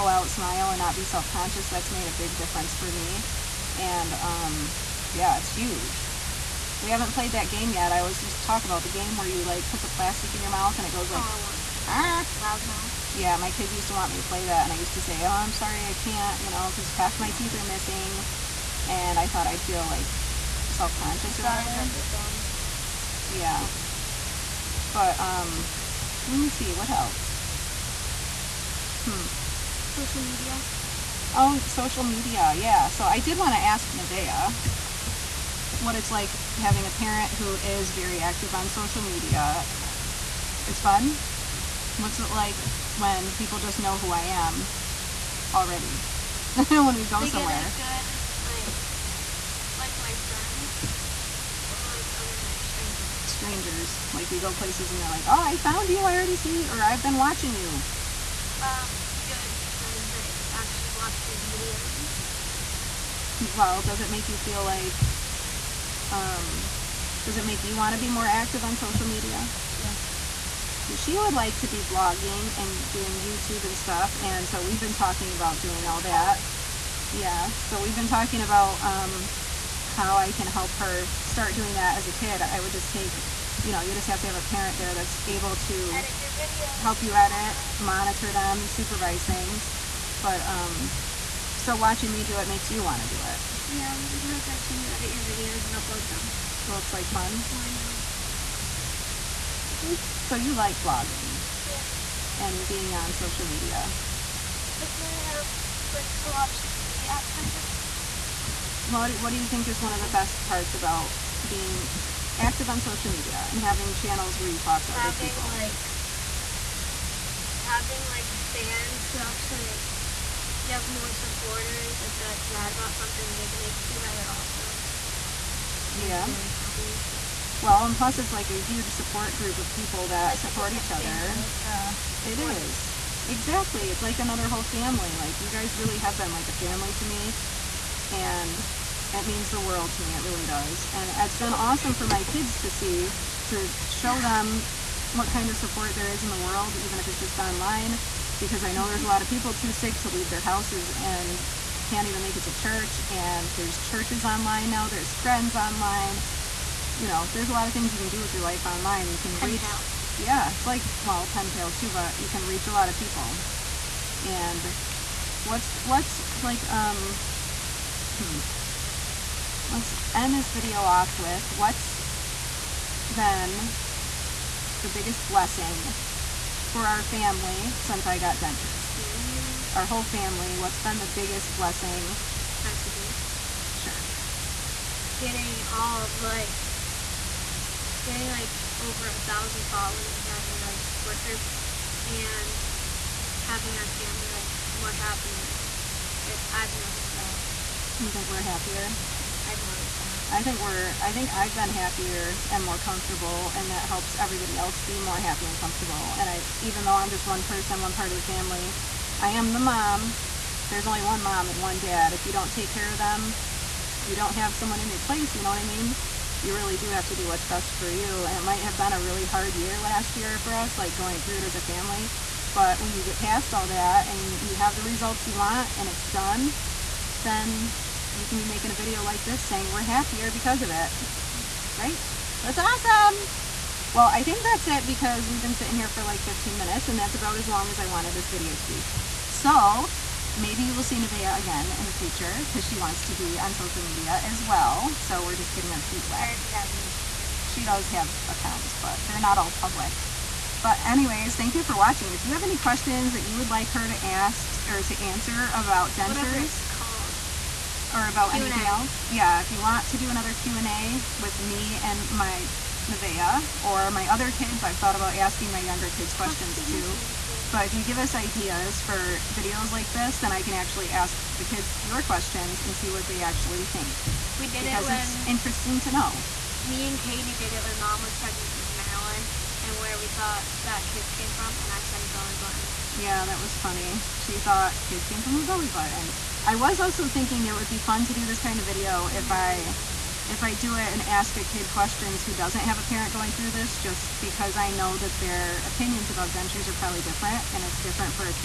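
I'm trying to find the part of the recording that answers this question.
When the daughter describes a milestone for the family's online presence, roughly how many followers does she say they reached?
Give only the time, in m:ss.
3:08.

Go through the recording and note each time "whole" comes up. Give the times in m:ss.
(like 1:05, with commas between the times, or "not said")
2:14, 2:59.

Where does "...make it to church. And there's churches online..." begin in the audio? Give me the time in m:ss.
2:32.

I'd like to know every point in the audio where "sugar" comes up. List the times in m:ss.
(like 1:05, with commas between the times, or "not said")
not said.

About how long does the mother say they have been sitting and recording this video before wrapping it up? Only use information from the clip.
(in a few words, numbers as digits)
15 minutes.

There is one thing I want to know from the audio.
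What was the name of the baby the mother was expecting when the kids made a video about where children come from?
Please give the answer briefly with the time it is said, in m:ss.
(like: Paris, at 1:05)
Marilyn, at 4:38.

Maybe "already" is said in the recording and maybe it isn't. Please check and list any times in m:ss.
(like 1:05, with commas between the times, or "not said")
0:45, 0:56, 4:06.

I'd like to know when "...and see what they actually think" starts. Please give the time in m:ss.
4:32.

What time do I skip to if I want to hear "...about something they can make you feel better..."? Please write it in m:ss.
2:02.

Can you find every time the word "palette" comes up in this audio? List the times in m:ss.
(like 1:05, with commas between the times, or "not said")
not said.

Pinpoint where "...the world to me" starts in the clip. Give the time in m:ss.
2:19.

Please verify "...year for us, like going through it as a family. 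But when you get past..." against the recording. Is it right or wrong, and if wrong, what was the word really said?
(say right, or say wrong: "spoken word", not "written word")
right.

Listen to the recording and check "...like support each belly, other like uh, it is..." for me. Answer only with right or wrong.
wrong.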